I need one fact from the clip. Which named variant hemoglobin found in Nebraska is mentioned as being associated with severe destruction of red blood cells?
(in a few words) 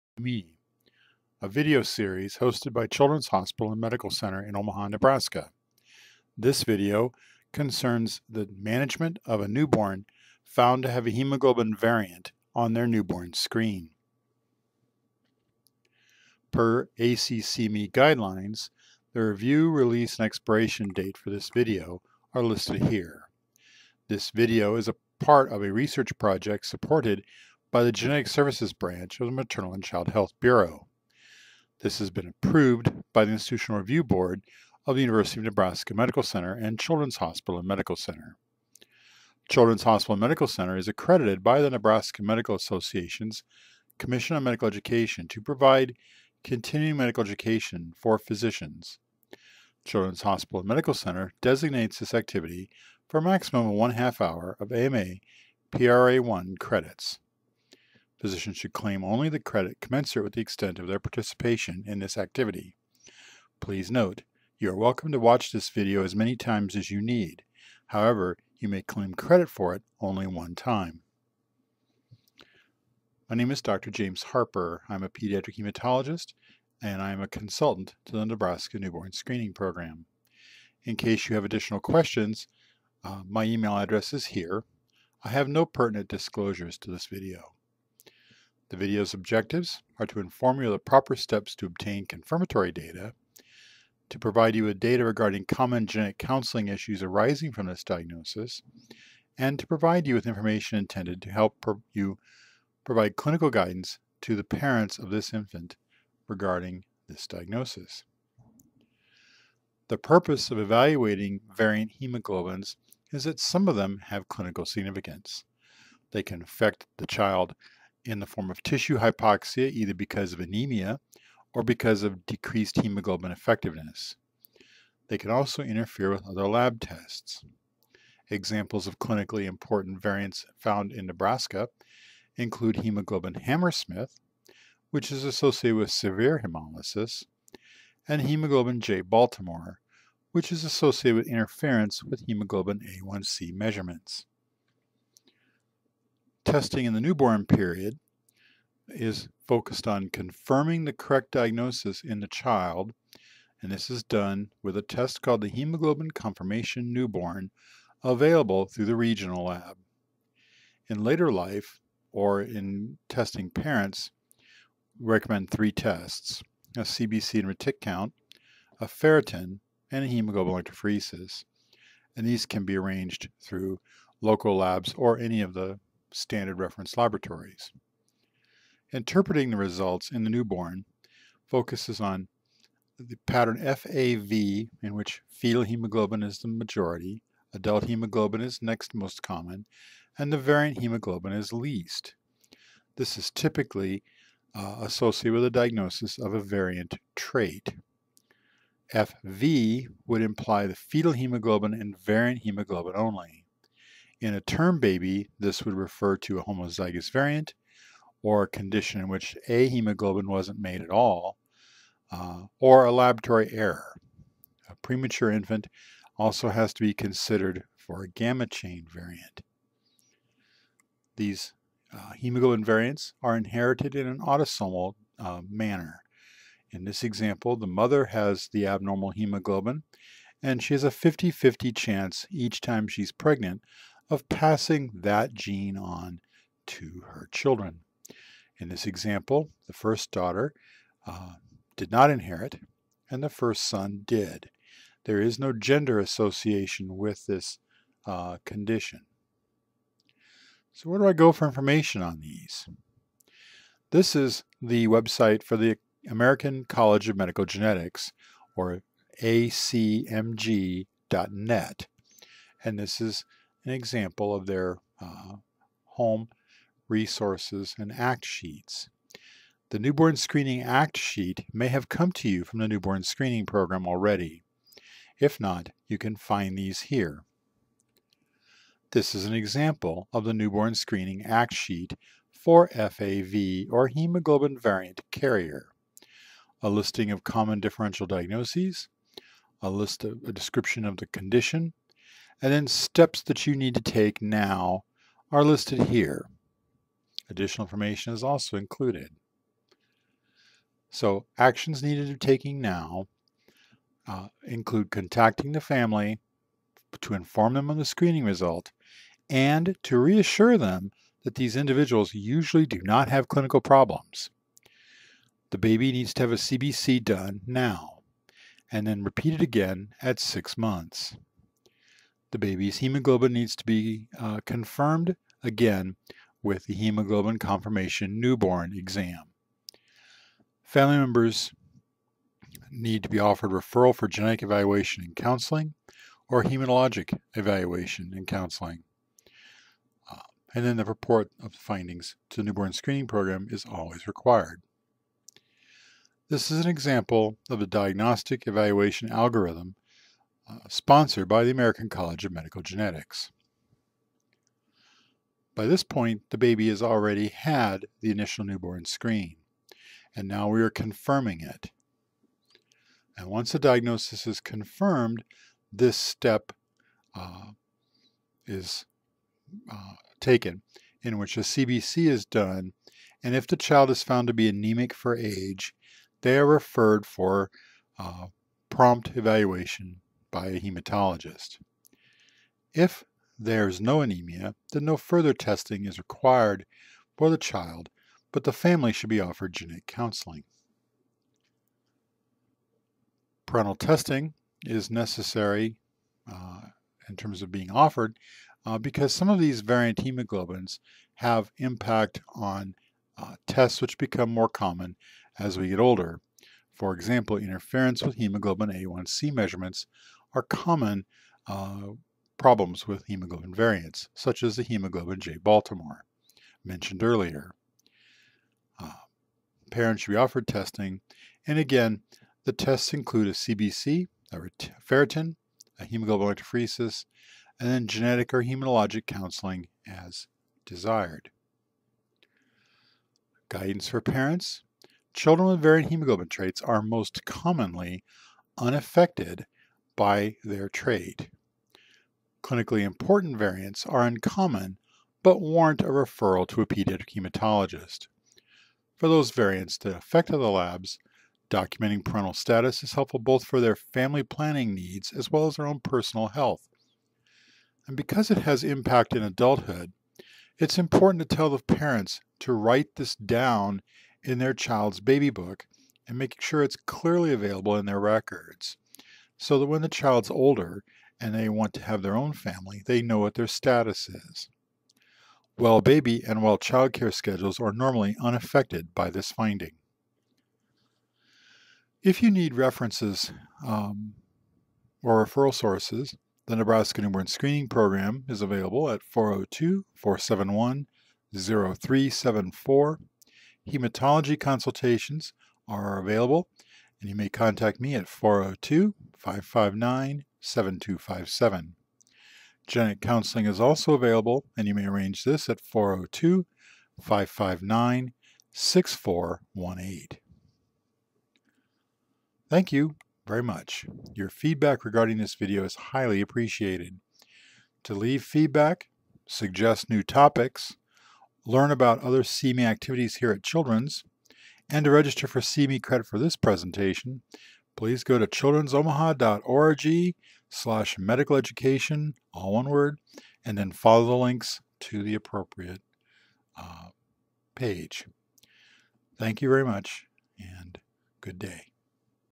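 hemoglobin Hammersmith.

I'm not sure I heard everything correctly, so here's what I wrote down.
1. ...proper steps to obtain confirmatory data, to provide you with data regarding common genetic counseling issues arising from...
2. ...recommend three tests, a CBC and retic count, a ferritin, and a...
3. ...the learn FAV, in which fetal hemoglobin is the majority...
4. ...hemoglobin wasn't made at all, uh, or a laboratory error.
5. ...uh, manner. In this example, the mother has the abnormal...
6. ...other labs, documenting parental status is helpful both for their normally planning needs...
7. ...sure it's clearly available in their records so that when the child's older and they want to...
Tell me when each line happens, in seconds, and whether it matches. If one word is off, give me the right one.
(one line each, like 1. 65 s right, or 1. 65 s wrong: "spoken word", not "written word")
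1. 90 s right
2. 165 s right
3. 182 s wrong: "pattern", not "learn"
4. 209 s right
5. 225 s right
6. 450 s wrong: "family", not "normally"
7. 466 s right.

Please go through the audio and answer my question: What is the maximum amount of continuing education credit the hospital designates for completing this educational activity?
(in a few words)
one half hour.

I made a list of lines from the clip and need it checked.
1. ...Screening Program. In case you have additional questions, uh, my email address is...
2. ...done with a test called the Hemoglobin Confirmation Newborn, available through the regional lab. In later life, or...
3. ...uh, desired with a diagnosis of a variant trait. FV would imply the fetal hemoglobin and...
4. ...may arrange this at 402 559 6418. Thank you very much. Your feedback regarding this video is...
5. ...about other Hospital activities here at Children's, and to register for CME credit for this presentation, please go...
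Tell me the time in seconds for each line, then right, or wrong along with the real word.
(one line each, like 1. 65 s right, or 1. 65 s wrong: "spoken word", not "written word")
1. 79 s right
2. 154 s right
3. 194 s wrong: "associated", not "desired"
4. 504 s right
5. 521 s wrong: "CME", not "Hospital".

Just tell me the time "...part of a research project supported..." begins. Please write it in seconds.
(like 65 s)
25 s.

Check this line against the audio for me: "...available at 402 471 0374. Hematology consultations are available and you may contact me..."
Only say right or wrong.
right.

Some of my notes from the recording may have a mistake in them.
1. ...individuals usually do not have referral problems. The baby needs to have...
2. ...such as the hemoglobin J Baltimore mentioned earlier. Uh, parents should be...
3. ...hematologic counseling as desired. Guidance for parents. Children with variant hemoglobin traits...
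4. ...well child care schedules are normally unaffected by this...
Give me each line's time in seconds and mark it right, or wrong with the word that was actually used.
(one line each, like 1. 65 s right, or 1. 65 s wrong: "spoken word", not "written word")
1. 311 s wrong: "clinical", not "referral"
2. 414 s right
3. 428 s right
4. 476 s right.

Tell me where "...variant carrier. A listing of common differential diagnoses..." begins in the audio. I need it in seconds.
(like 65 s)
284 s.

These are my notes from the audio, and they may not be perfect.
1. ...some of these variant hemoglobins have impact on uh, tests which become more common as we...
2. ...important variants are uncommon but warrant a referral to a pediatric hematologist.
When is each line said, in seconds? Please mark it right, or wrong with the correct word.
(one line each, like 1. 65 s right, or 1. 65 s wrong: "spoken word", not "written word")
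1. 399 s right
2. 442 s right.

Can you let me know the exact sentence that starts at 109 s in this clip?
The purpose of evaluating variant hemoglobins is that some of them have clinical significance.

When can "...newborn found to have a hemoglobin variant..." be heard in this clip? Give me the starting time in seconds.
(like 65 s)
9 s.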